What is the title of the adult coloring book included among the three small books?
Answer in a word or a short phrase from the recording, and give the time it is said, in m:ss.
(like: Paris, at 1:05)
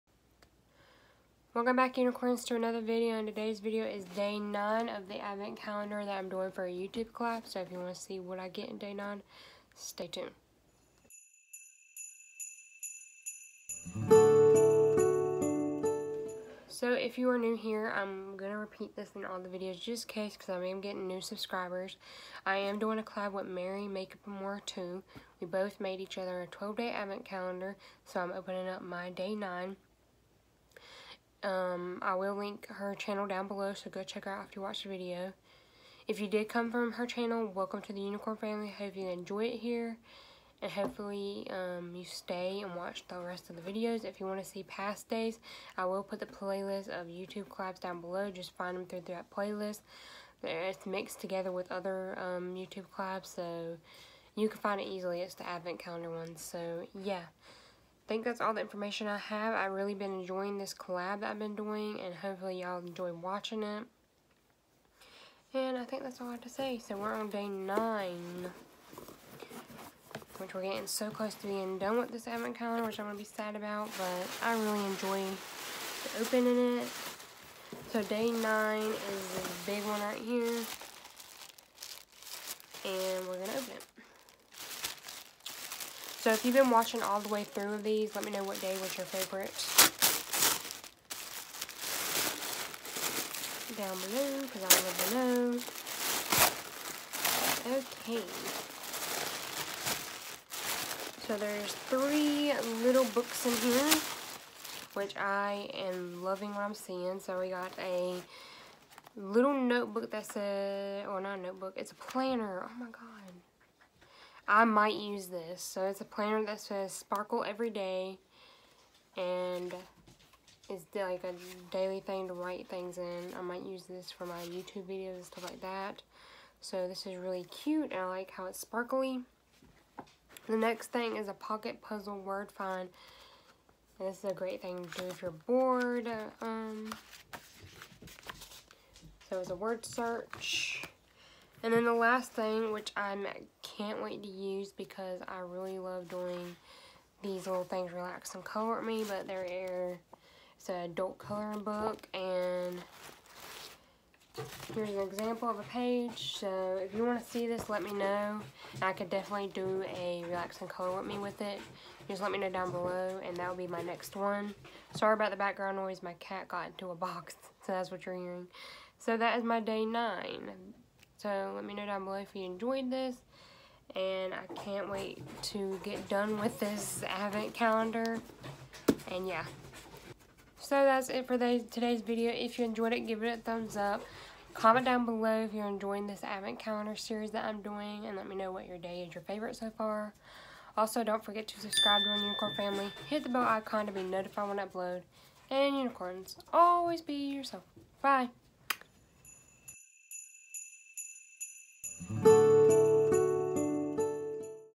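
Relax and Color Me, at 2:27.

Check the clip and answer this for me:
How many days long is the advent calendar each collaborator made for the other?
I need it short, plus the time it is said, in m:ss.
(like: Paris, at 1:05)
12, at 0:26.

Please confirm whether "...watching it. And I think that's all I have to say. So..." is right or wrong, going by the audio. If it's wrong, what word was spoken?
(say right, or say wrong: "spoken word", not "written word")
right.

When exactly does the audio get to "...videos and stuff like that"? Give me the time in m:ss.
2:04.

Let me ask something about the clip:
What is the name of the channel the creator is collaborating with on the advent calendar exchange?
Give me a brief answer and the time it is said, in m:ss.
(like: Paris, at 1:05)
Mary Makeup and More, at 0:23.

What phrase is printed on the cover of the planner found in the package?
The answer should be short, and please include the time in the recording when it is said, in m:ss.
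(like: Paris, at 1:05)
sparkle every day, at 1:56.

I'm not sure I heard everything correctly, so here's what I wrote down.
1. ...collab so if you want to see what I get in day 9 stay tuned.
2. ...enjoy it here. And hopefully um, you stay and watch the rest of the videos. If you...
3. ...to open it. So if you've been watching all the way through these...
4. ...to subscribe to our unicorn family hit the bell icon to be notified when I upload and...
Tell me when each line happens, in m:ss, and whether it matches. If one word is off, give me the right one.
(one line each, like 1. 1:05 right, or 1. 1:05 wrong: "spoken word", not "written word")
1. 0:07 right
2. 0:39 right
3. 1:23 right
4. 3:11 right.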